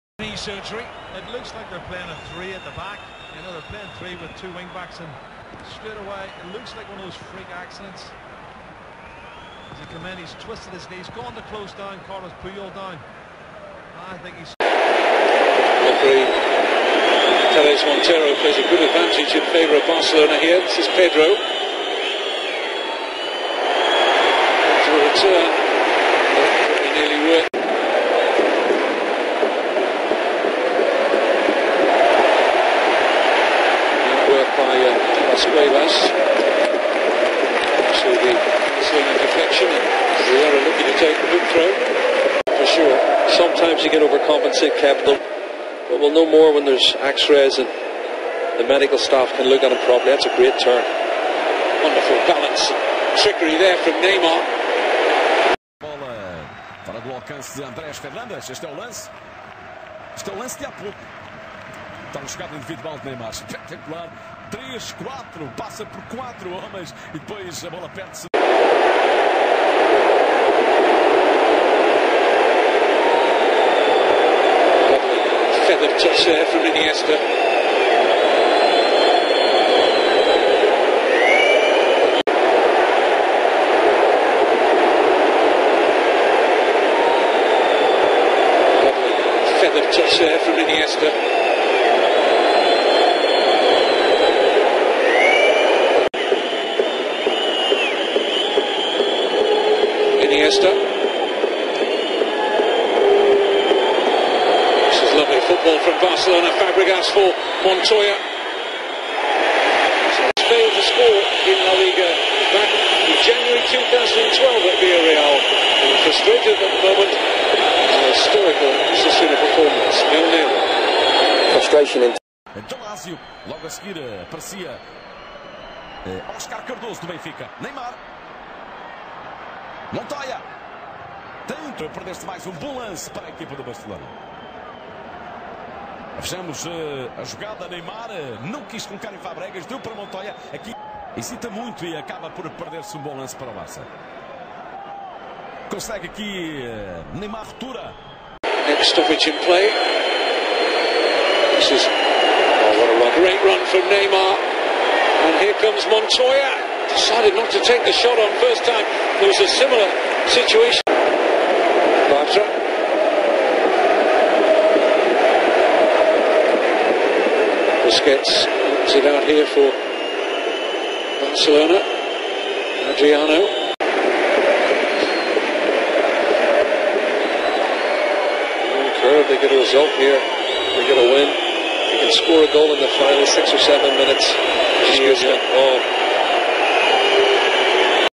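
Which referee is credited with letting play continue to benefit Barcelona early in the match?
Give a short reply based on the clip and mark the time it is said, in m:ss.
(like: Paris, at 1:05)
Teles Montero, at 0:17.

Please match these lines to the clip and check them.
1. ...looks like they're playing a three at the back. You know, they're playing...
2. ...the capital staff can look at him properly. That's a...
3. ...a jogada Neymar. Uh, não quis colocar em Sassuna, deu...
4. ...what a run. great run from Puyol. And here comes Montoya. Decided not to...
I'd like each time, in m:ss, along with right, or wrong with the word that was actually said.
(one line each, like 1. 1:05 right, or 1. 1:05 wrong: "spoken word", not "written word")
1. 0:01 right
2. 0:48 wrong: "medical", not "capital"
3. 2:17 wrong: "Fabregas", not "Sassuna"
4. 2:32 wrong: "Neymar", not "Puyol".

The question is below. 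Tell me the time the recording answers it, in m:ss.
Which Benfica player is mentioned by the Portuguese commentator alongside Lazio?
2:06.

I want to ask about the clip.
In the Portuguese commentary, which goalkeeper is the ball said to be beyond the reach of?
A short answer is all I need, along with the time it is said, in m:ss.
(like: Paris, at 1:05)
Andrés Fernández, at 0:57.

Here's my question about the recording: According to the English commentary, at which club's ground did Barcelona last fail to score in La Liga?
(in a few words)
Villarreal.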